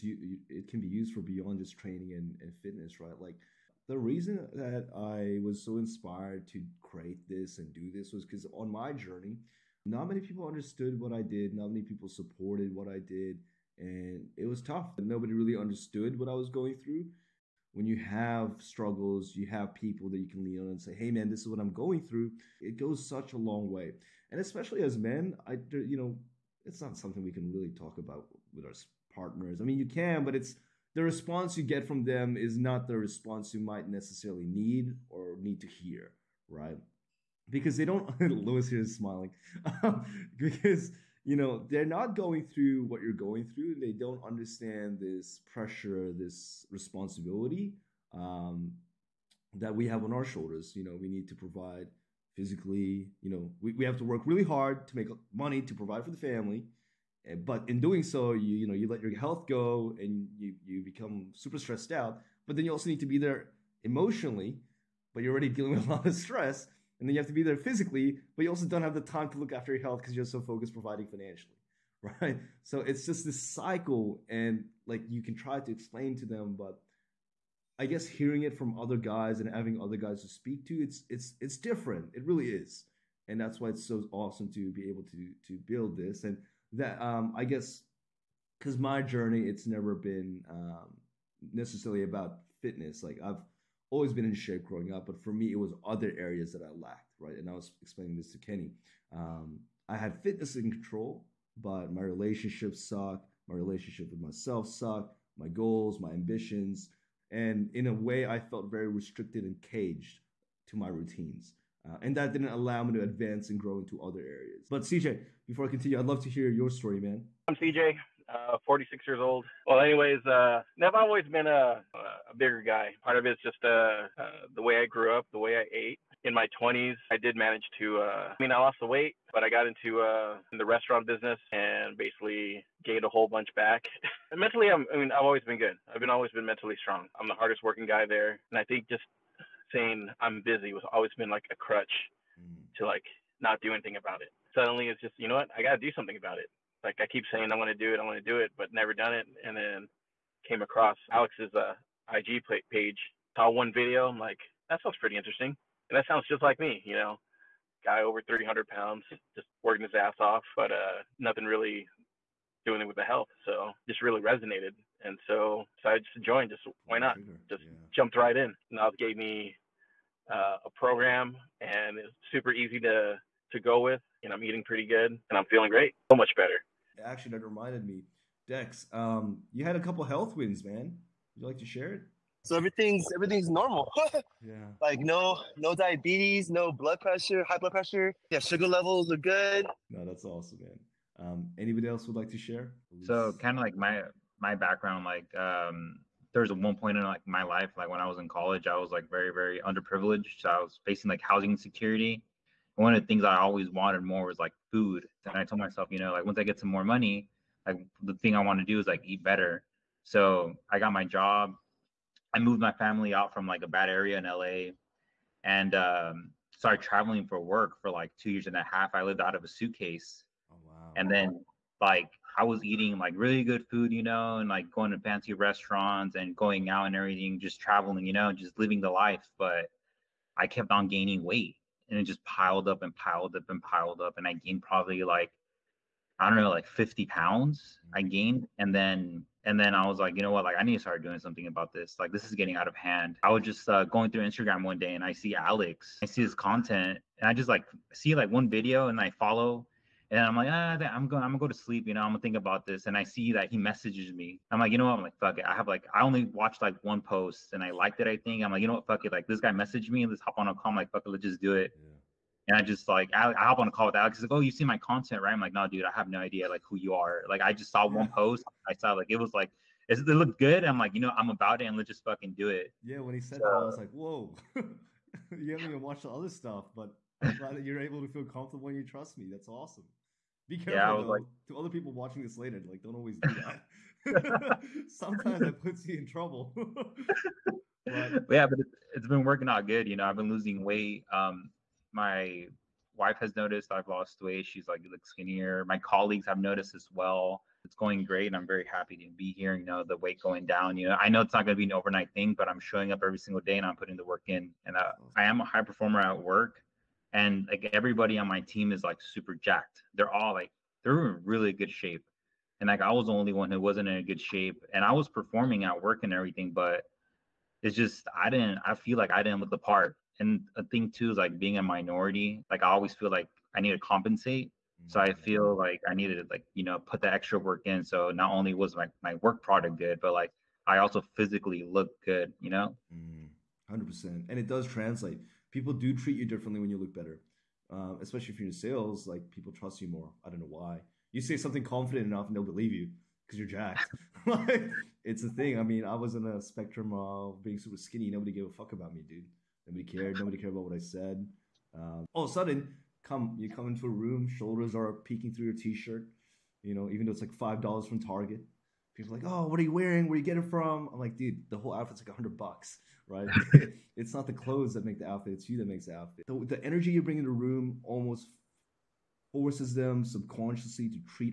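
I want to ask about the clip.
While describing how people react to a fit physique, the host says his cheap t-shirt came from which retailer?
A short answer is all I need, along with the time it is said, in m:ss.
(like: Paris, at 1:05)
Target, at 5:58.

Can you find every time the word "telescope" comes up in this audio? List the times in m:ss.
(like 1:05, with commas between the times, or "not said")
not said.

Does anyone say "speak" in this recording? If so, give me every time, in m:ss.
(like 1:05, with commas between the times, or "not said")
1:20.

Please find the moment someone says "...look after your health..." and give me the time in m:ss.
1:09.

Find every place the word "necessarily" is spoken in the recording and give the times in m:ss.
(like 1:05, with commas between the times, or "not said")
0:33, 1:31.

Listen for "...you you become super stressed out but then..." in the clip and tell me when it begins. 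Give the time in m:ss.
1:00.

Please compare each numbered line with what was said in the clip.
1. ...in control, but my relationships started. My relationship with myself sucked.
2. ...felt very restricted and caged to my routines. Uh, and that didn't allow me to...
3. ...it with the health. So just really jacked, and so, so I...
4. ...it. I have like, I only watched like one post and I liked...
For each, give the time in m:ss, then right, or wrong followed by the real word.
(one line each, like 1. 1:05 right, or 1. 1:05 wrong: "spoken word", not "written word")
1. 1:40 wrong: "sucked", not "started"
2. 1:48 right
3. 2:42 wrong: "resonated", not "jacked"
4. 4:15 right.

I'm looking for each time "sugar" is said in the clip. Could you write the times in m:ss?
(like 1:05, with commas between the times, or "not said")
3:08.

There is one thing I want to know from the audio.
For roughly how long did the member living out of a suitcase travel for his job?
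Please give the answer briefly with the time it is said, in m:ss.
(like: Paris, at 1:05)
2 and a half years, at 3:38.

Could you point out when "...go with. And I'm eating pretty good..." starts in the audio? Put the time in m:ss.
2:53.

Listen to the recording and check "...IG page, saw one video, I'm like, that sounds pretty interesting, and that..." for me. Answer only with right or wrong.
right.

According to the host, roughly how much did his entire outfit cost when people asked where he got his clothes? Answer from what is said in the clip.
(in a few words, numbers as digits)
$100.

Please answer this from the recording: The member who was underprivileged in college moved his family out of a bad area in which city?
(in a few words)
LA.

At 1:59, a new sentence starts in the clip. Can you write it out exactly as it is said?
Well, anyways, uh, now I've always been a, a bigger guy.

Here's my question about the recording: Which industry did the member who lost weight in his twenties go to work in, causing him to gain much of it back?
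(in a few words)
restaurant business.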